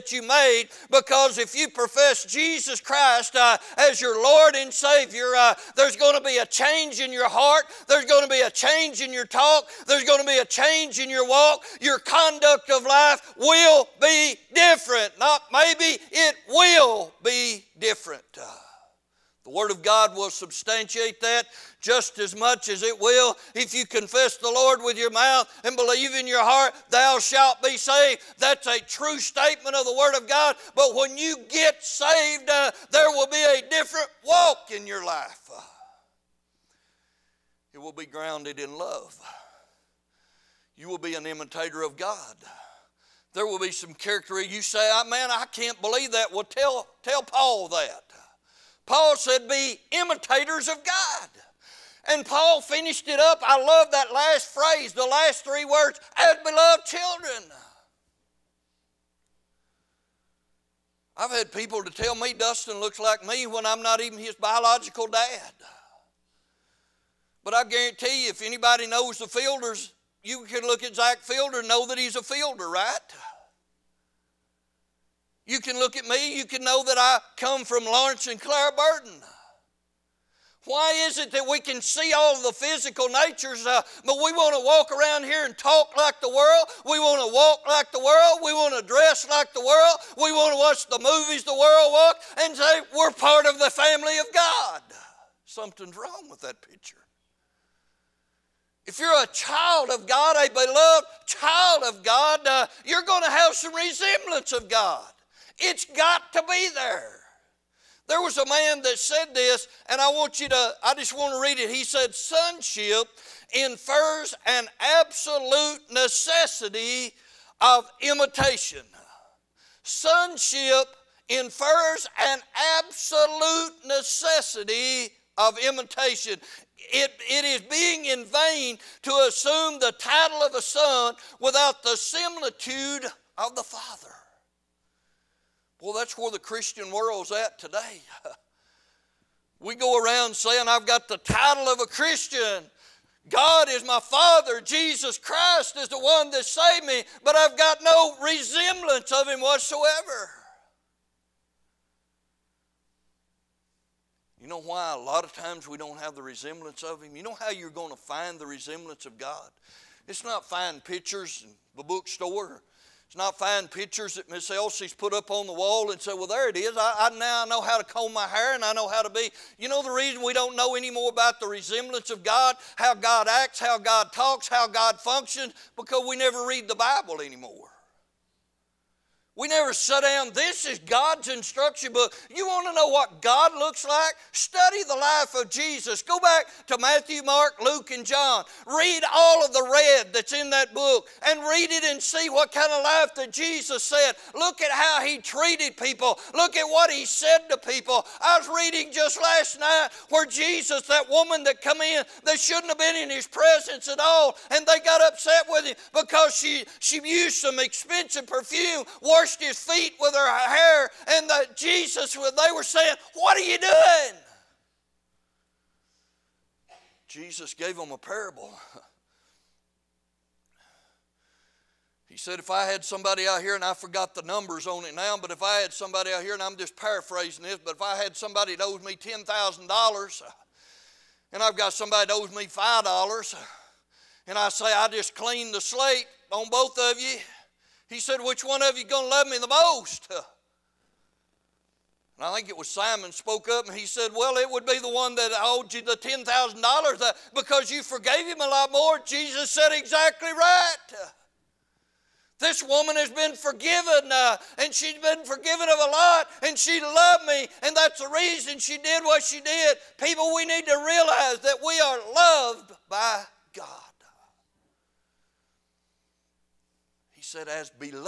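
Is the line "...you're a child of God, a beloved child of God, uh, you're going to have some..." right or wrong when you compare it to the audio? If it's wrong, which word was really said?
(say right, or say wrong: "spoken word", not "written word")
right.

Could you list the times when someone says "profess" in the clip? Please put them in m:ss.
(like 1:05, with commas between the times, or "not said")
0:01.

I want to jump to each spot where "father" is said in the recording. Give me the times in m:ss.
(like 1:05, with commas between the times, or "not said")
2:13, 2:24.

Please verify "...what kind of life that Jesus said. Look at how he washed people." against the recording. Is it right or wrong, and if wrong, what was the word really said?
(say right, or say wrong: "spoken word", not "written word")
wrong: "treated", not "washed".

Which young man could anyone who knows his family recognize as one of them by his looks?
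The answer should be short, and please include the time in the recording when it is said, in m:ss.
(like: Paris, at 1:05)
Zach Fielder, at 1:10.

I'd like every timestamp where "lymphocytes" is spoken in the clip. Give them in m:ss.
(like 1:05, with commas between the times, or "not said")
not said.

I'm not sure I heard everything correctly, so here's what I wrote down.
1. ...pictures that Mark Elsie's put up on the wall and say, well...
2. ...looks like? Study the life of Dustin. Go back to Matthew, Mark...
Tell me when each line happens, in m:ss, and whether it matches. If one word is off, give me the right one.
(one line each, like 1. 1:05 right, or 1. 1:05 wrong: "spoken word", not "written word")
1. 2:43 wrong: "Miss", not "Mark"
2. 3:03 wrong: "Jesus", not "Dustin".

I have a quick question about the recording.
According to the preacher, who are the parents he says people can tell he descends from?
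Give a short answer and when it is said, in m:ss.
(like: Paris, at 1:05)
Lawrence and Clara Burdin, at 1:17.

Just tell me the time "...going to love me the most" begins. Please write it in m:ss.
3:58.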